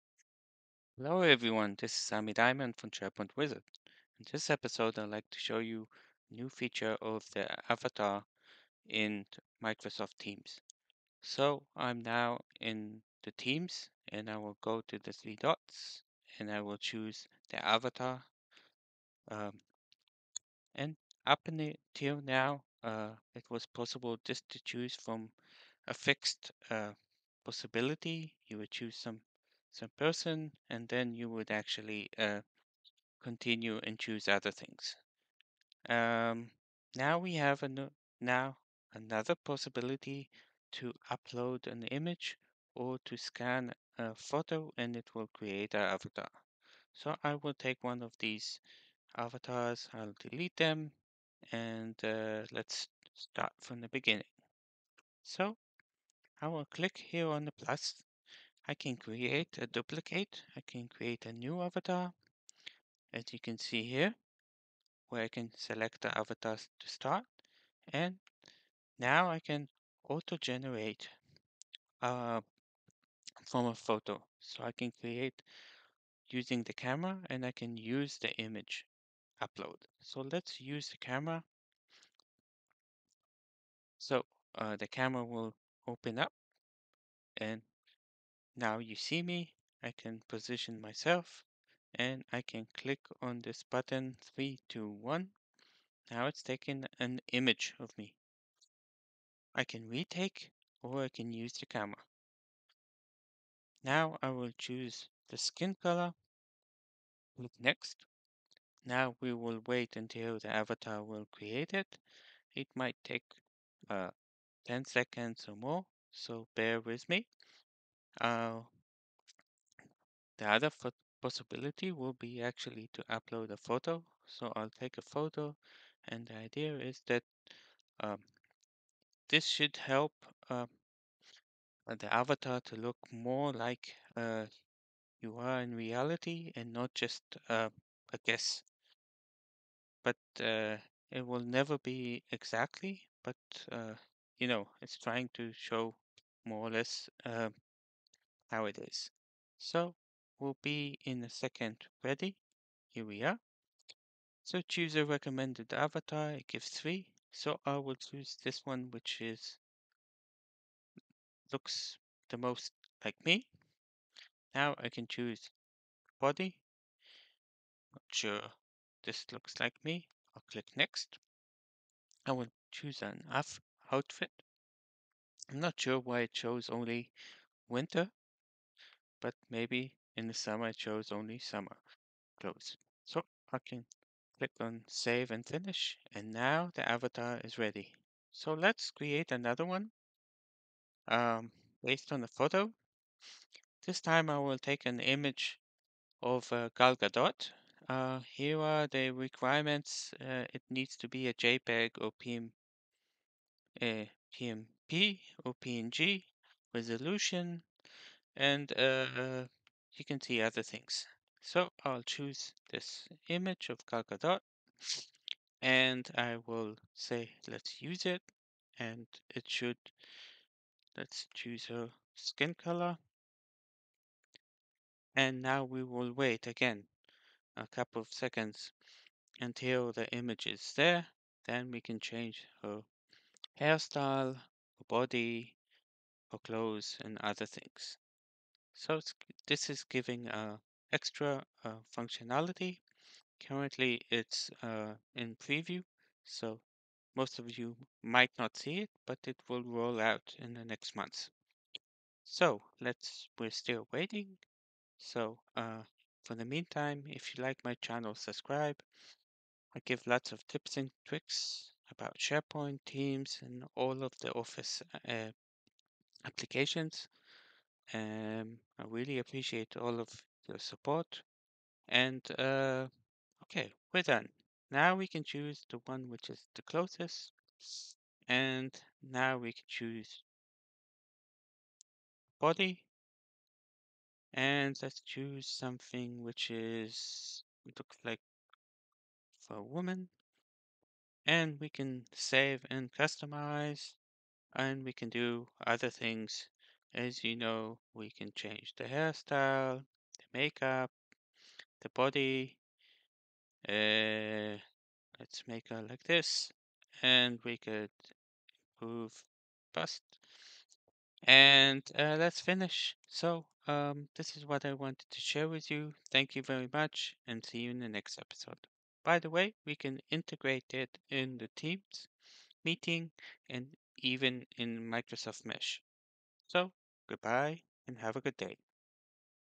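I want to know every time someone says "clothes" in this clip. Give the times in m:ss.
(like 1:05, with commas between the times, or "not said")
3:02, 3:56.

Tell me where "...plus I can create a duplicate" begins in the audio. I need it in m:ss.
0:57.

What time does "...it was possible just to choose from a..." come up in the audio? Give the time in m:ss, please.
0:23.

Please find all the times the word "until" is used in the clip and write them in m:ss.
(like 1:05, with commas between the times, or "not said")
0:21, 1:49, 3:49.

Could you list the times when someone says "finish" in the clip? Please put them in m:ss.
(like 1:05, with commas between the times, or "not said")
3:05, 5:12.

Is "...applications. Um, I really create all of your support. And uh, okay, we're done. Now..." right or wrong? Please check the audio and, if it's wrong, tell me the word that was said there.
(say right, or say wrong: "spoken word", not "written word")
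wrong: "appreciate", not "create".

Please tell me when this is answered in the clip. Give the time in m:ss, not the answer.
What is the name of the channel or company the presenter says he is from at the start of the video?
0:02.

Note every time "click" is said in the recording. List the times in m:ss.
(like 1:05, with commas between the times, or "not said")
0:56, 1:32, 1:47, 2:50, 3:04.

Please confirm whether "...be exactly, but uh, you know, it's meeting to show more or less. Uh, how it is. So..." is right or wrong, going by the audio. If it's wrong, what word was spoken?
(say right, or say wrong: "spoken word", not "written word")
wrong: "trying", not "meeting".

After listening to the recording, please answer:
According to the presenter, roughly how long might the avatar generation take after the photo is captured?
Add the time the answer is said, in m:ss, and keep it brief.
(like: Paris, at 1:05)
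10 seconds, at 1:54.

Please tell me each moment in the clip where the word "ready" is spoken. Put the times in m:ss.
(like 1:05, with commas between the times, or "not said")
2:32, 3:07.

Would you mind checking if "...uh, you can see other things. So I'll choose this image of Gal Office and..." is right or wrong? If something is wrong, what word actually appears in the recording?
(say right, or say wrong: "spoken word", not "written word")
wrong: "Gadot", not "Office".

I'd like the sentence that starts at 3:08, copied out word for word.
So let's create another one um, based on the photo.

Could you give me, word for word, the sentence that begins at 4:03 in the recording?
Currently it's uh, in preview, so most of you might not see it, but it will roll out in the next months.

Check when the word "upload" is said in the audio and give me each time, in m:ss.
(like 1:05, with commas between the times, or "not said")
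0:41, 1:19, 2:03.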